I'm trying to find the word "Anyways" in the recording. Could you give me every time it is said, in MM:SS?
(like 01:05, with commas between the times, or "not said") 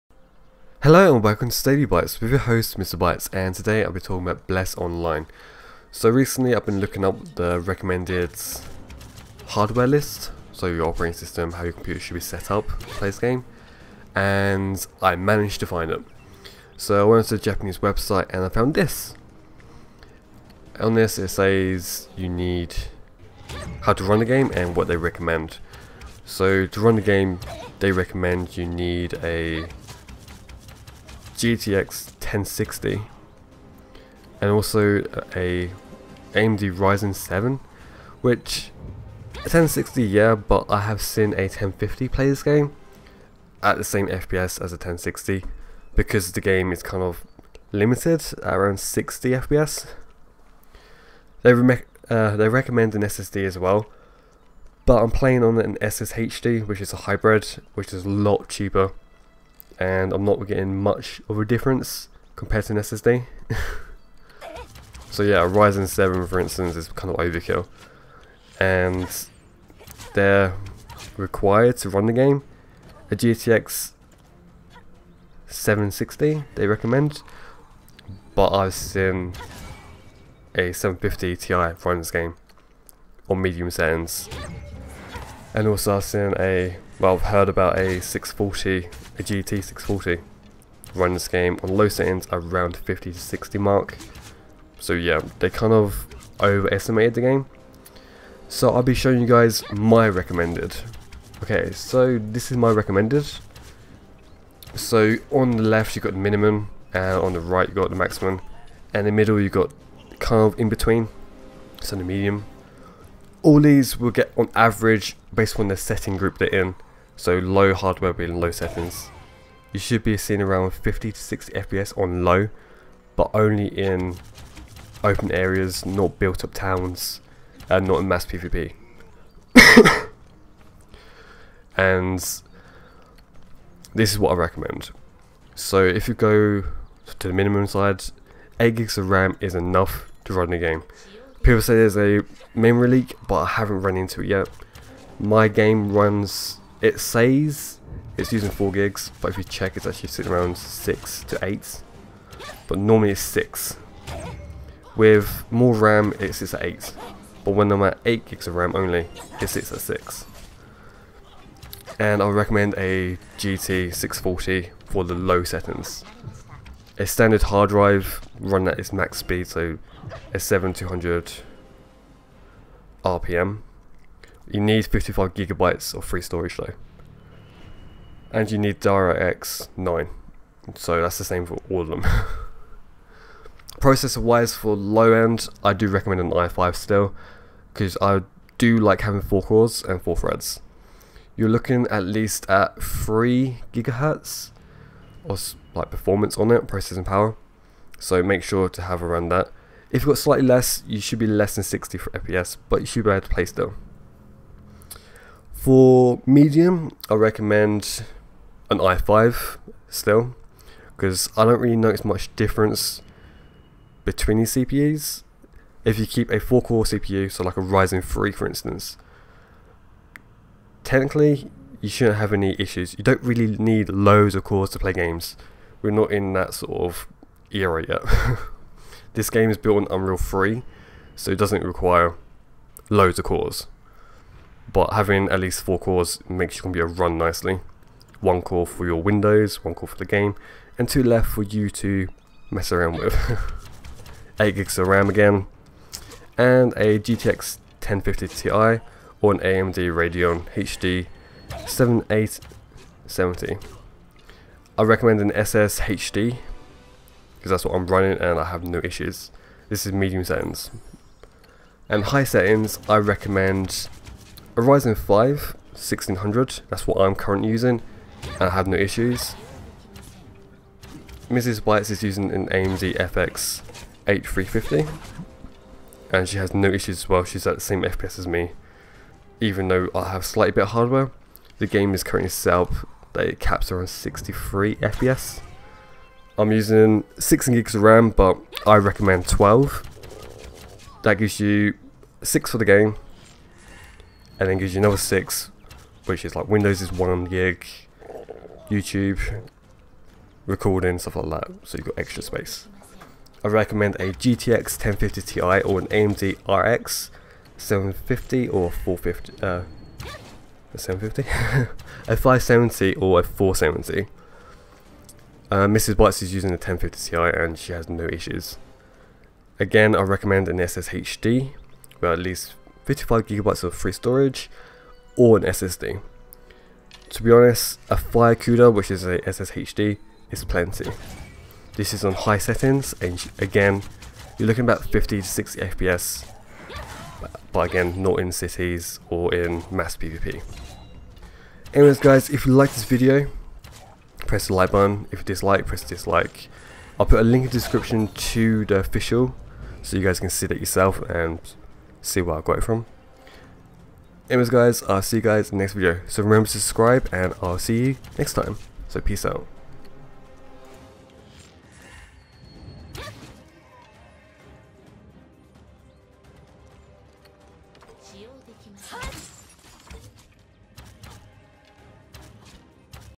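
05:41, 05:54.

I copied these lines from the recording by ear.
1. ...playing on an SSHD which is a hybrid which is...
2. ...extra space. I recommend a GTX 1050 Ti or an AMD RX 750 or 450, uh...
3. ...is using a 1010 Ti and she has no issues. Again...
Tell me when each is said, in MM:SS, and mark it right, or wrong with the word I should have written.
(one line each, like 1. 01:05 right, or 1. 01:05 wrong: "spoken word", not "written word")
1. 00:55 right
2. 05:01 right
3. 05:16 wrong: "1050", not "1010".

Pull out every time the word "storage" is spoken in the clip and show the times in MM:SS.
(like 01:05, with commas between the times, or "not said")
02:56, 05:23.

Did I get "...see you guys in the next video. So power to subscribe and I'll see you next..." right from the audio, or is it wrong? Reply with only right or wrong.
wrong.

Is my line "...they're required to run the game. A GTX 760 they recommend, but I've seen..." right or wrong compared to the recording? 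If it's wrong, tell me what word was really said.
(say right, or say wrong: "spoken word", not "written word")
right.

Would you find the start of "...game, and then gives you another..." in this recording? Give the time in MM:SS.
04:52.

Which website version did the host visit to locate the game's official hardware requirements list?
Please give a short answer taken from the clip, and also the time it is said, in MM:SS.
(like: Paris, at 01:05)
Japanese, at 00:17.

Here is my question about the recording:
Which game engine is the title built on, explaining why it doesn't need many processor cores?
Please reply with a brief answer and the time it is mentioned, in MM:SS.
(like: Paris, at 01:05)
Unreal 3, at 03:49.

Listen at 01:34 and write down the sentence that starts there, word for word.
So yeah, they kind of overestimated the game.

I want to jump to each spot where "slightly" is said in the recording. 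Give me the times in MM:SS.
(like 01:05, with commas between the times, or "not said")
03:20, 04:40.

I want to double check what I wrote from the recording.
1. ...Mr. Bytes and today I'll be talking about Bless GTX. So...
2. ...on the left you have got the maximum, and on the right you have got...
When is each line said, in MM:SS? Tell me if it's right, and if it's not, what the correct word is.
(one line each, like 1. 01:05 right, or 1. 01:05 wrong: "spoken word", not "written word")
1. 00:02 wrong: "Online", not "GTX"
2. 01:45 wrong: "minimum", not "maximum".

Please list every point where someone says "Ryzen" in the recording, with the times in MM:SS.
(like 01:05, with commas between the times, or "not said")
00:36, 01:05, 03:37, 04:24.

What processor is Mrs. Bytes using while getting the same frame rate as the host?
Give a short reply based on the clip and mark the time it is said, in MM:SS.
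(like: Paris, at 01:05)
AMD FX 8350, at 04:32.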